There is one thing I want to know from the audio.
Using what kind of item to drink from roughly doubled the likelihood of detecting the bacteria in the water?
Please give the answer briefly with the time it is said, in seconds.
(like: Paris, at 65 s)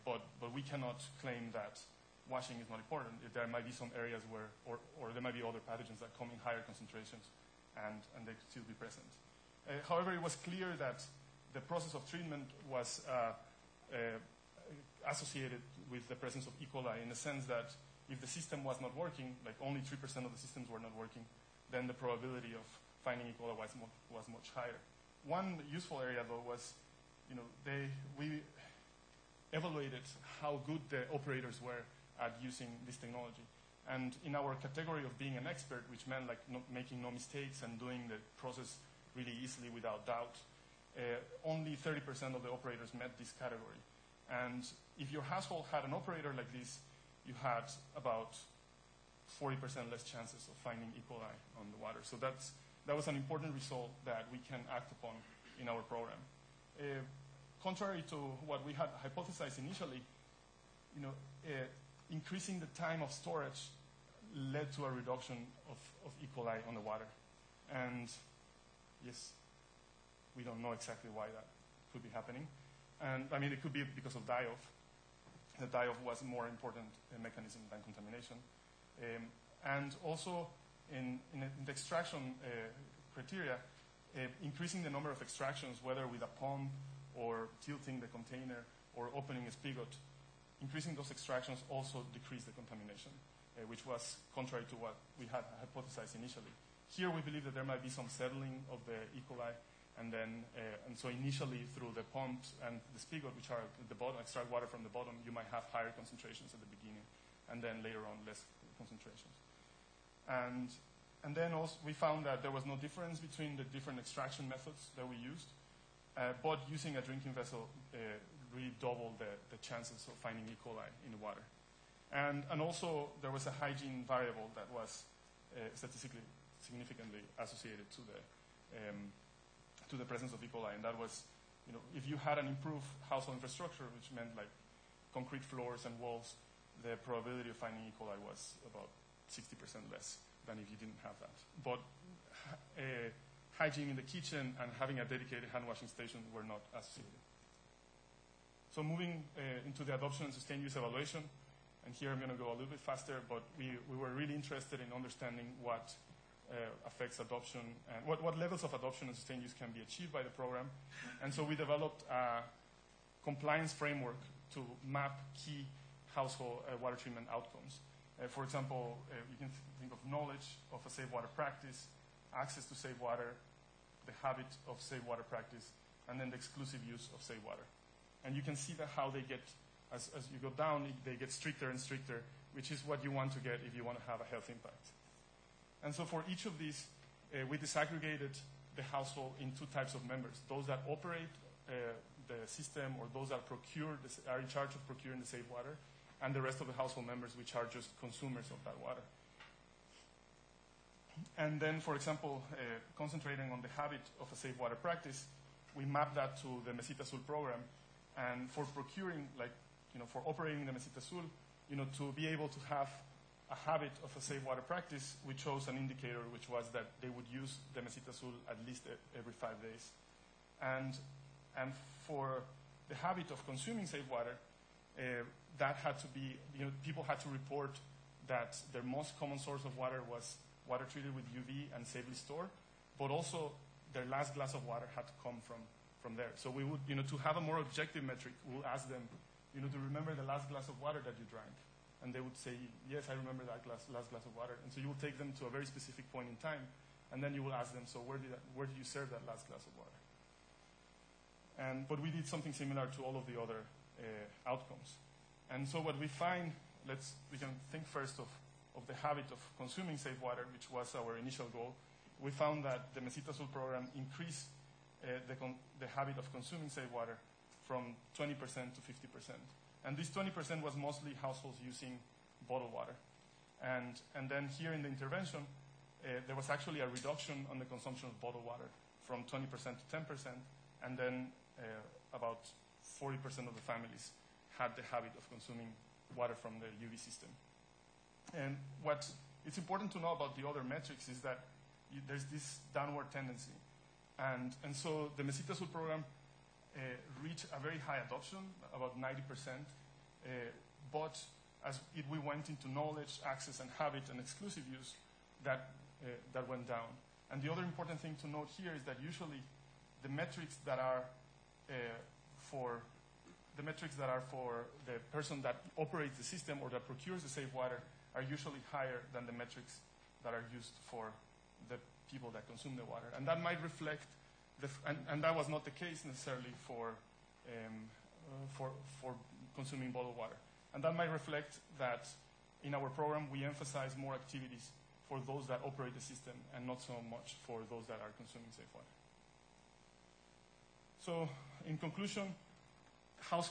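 A drinking vessel, at 117 s.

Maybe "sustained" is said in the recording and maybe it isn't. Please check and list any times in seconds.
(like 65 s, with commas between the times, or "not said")
150 s, 159 s.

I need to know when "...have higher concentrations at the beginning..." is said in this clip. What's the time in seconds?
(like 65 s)
105 s.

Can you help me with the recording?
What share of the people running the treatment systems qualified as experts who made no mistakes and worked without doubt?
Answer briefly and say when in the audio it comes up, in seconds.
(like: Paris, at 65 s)
30%, at 41 s.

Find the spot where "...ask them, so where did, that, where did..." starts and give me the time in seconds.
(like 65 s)
247 s.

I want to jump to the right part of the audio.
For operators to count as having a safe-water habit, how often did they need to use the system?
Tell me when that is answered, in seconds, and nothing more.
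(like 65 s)
218 s.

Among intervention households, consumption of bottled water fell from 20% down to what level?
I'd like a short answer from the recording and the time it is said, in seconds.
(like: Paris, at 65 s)
10%, at 279 s.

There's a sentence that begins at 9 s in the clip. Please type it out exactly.
Uh, however, it was clear that the process of treatment was uh, uh, associated with the presence of E.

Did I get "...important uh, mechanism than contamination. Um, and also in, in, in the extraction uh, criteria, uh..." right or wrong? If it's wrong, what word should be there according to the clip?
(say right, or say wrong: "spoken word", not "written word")
right.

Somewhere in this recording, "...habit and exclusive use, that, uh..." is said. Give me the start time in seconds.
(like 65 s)
303 s.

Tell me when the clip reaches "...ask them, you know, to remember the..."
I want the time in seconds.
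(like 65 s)
238 s.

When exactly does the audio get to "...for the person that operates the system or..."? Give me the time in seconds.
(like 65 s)
314 s.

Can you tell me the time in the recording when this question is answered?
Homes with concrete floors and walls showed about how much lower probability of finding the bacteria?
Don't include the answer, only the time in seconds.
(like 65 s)
138 s.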